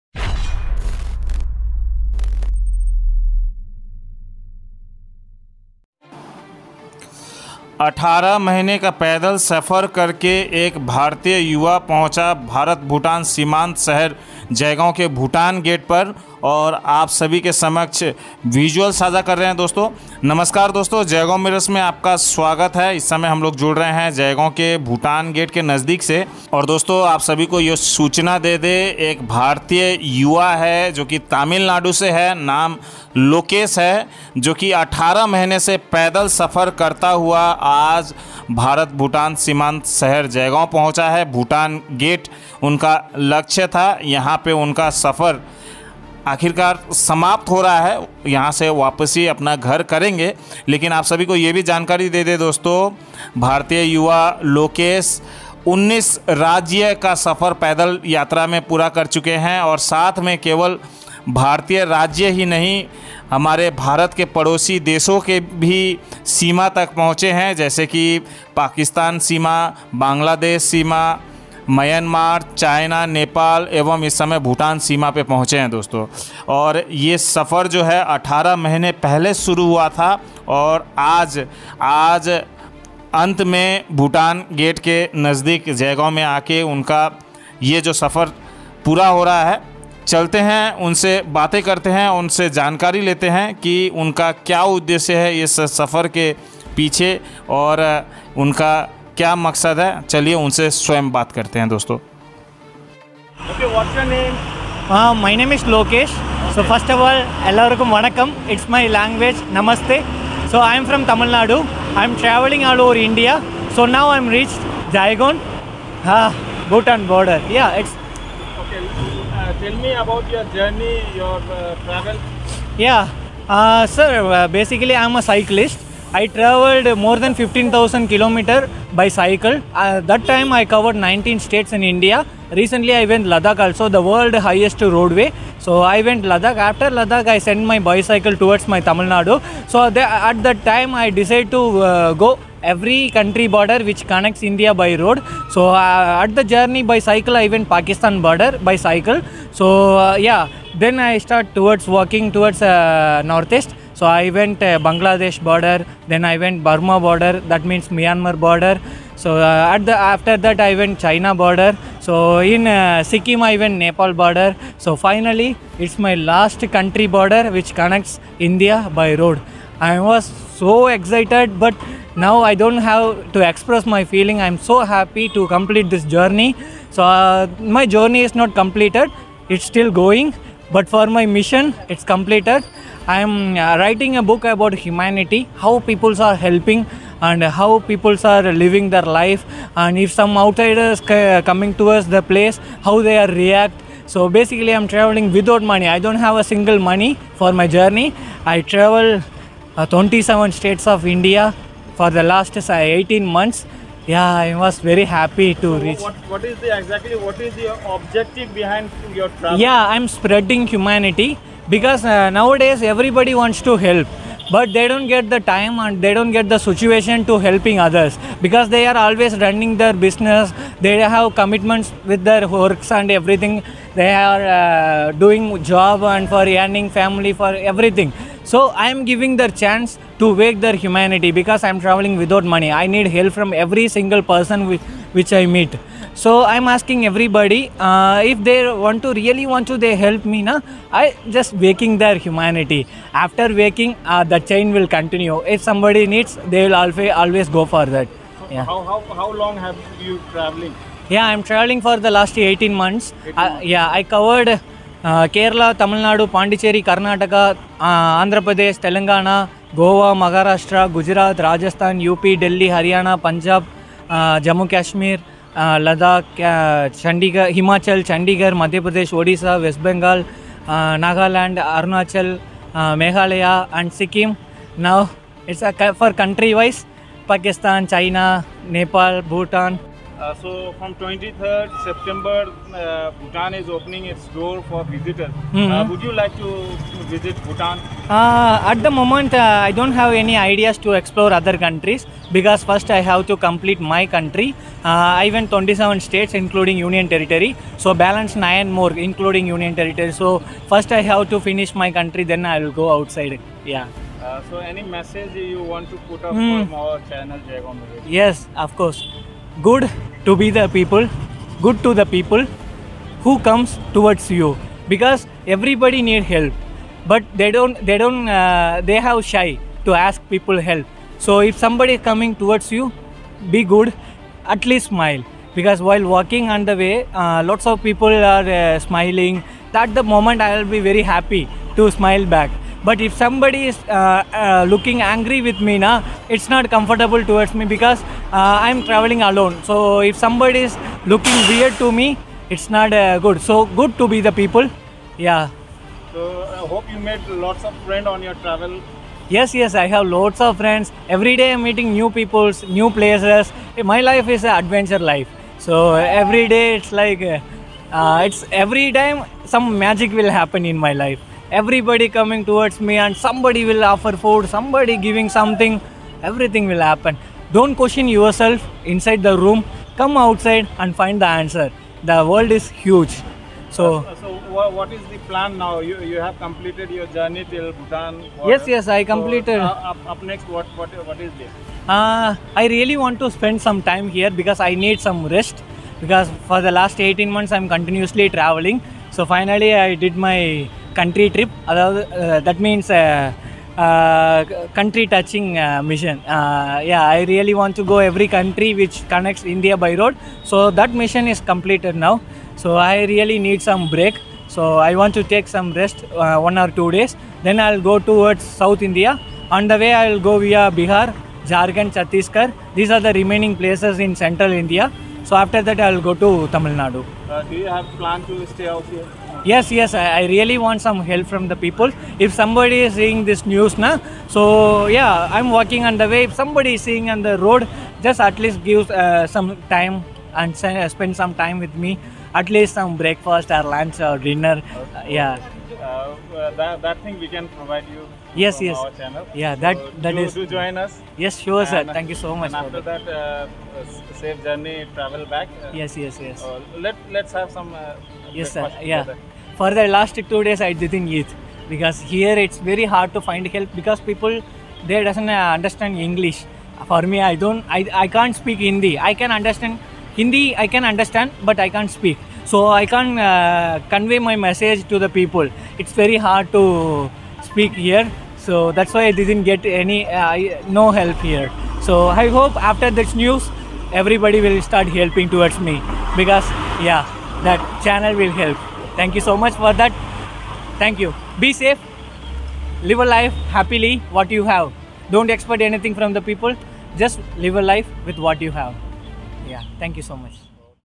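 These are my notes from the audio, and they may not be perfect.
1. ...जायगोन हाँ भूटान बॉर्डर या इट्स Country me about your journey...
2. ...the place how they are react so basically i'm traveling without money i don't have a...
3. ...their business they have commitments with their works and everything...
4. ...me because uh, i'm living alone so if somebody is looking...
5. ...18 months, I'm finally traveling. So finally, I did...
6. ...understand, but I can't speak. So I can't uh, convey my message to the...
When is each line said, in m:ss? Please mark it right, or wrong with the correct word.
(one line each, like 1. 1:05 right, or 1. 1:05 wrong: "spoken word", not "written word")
1. 1:54 wrong: "Tell", not "Country"
2. 3:12 right
3. 3:39 right
4. 5:37 wrong: "traveling", not "living"
5. 6:26 wrong: "continuously", not "finally"
6. 7:40 right.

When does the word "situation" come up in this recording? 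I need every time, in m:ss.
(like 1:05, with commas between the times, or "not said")
3:36.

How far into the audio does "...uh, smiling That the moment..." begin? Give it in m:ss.
5:28.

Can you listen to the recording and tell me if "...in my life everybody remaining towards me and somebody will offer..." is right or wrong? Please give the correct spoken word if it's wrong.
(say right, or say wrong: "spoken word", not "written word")
wrong: "coming", not "remaining".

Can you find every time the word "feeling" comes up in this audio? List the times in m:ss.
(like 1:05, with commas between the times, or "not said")
2:54.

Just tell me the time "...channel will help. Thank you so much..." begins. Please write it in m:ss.
7:57.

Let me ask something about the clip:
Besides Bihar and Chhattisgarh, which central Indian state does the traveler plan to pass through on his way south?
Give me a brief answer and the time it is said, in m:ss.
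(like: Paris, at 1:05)
Jharkhand, at 6:51.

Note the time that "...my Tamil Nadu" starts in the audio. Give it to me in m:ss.
2:18.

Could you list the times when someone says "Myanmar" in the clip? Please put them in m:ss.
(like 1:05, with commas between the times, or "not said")
2:37.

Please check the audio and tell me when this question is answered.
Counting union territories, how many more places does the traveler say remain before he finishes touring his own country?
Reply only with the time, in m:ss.
4:58.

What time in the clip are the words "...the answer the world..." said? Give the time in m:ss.
6:11.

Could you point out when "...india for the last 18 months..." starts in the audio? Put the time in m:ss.
3:21.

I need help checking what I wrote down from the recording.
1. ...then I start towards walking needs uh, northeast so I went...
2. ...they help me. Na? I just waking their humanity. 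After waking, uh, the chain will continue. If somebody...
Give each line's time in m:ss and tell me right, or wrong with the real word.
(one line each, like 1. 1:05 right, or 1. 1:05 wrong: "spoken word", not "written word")
1. 2:30 wrong: "towards", not "needs"
2. 3:59 right.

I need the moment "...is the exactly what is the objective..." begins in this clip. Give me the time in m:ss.
3:26.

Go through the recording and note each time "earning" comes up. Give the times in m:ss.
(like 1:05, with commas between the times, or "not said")
3:46.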